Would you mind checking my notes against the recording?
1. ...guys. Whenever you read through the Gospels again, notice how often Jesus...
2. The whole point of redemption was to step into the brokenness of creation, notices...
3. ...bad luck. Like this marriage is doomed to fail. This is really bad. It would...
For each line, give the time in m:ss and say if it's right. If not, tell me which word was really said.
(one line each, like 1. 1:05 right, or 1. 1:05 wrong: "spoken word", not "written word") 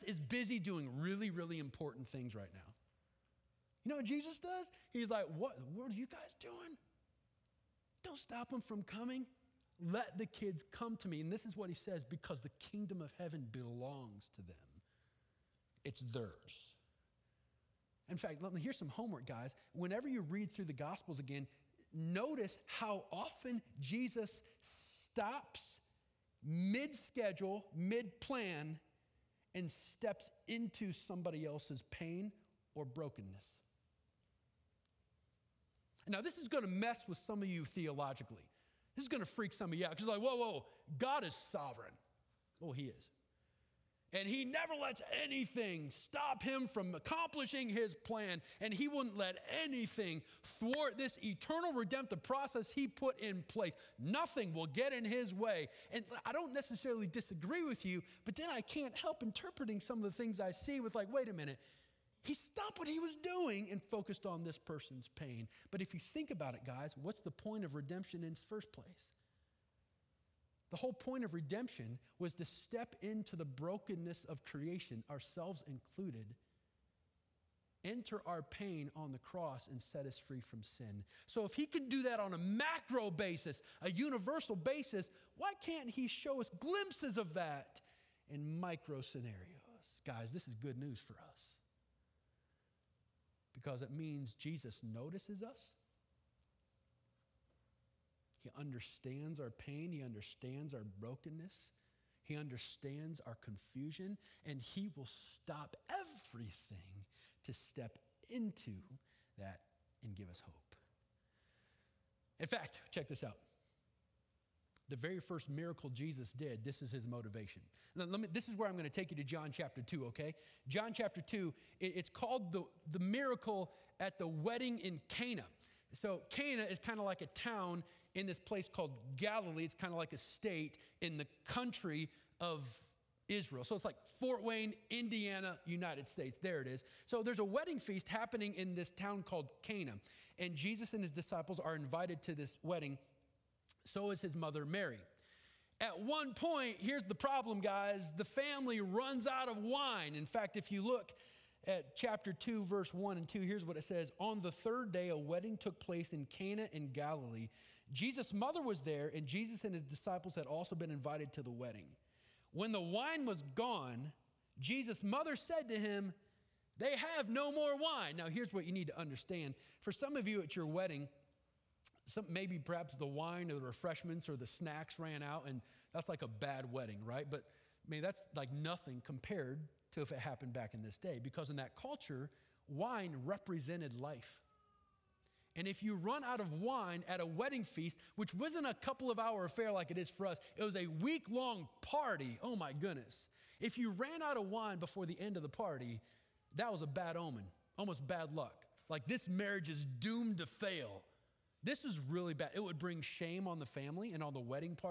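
1. 0:19 right
2. 1:10 wrong: "ourselves", not "notices"
3. 3:18 right.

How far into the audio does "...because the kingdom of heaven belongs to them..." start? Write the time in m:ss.
0:12.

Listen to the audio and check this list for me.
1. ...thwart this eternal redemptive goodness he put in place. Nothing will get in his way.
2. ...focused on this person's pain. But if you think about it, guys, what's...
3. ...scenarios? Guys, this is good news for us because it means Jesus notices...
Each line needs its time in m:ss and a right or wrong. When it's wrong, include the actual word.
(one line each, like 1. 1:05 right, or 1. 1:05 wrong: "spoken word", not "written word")
1. 0:50 wrong: "process", not "goodness"
2. 1:03 right
3. 1:28 right.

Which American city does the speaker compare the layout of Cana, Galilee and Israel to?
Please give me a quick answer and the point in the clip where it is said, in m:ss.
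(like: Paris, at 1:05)
Fort Wayne, at 2:14.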